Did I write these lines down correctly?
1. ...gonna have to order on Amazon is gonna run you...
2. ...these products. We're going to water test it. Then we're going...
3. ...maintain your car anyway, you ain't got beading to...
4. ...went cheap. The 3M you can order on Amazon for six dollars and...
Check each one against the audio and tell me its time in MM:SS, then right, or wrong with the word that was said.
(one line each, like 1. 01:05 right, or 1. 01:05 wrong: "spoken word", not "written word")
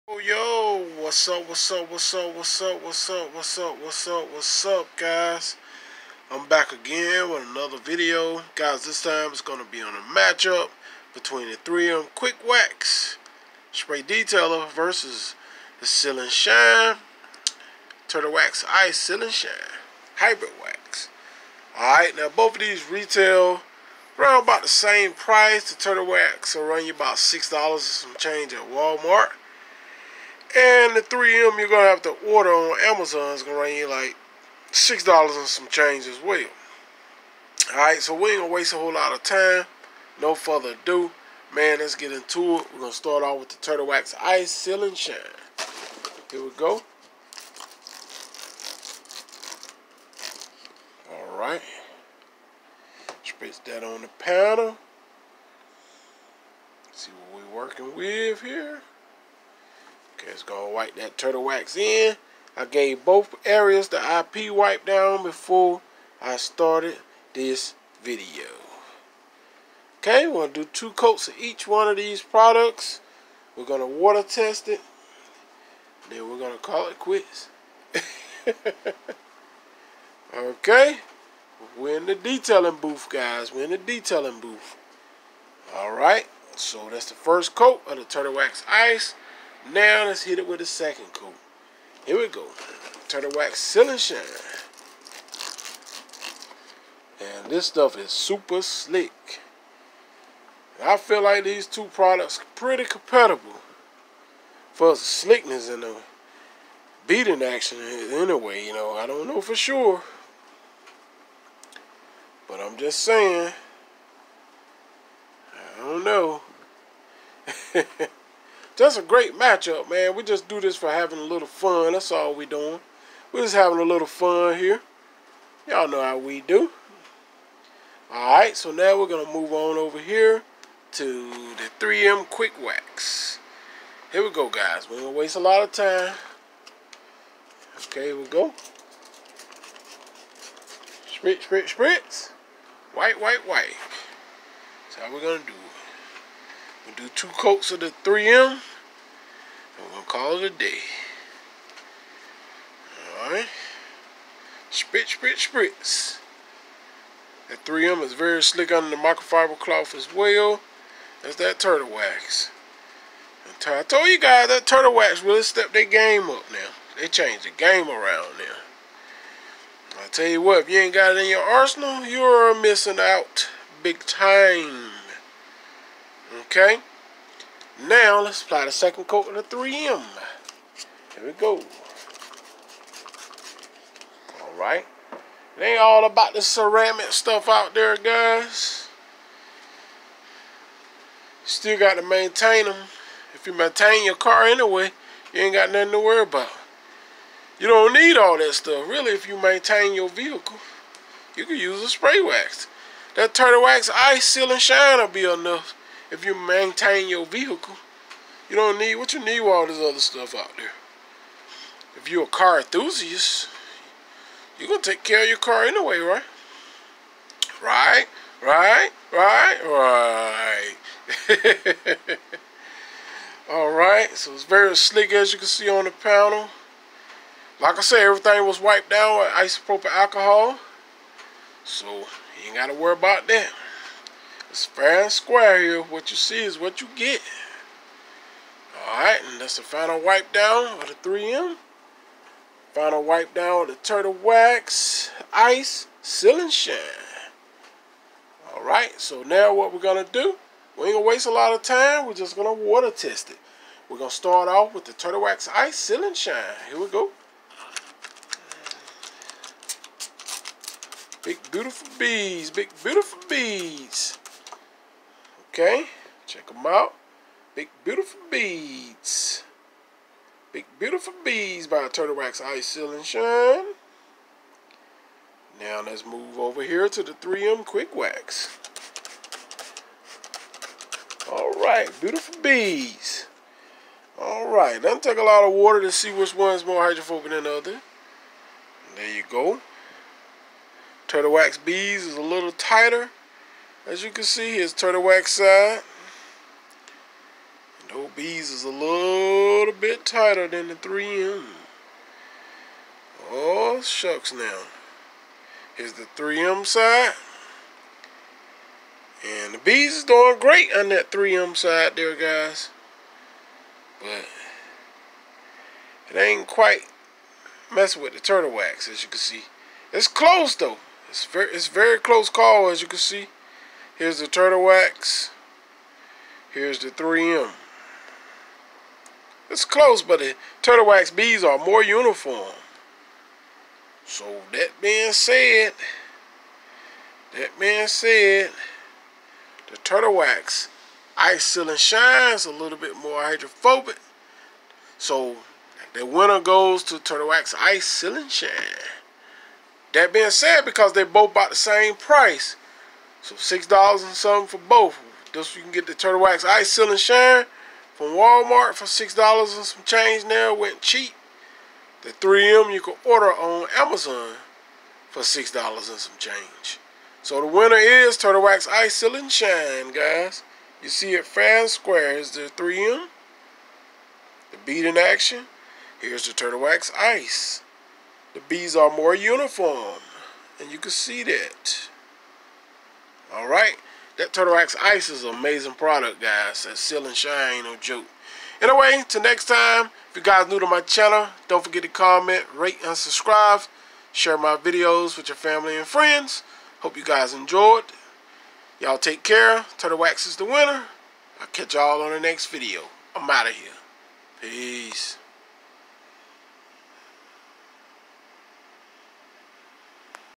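1. 00:31 right
2. 01:11 right
3. 03:13 wrong: "nothing", not "beading"
4. 06:00 right.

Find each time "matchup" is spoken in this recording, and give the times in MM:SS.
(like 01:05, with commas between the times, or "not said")
00:10, 01:59.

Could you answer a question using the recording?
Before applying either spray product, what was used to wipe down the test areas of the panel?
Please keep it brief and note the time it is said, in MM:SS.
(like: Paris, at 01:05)
IP wipe down, at 01:04.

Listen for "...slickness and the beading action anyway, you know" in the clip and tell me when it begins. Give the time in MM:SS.
01:44.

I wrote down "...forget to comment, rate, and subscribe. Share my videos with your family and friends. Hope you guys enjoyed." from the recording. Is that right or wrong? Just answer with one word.
right.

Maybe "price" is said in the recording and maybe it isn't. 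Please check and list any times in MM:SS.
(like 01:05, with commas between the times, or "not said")
00:25, 05:51.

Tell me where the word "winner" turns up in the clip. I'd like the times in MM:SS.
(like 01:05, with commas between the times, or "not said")
05:46, 06:07, 06:40.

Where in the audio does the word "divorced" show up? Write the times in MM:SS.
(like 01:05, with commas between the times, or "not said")
not said.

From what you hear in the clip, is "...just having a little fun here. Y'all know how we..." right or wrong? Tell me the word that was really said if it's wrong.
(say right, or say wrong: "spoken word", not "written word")
right.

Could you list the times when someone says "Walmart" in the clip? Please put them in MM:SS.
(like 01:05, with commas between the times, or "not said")
00:28, 05:58.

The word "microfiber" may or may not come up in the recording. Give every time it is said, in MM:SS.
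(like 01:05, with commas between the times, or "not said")
02:38.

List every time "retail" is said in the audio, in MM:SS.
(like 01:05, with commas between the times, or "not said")
00:22.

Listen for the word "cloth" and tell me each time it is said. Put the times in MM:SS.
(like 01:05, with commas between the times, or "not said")
02:39.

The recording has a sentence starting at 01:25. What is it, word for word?
Alright, so that's the first coat of the Turtle Wax Ice.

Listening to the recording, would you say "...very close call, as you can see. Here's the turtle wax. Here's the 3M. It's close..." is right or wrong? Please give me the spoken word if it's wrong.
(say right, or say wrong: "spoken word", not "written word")
right.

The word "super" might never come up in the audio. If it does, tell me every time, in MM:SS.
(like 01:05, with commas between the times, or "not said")
01:38.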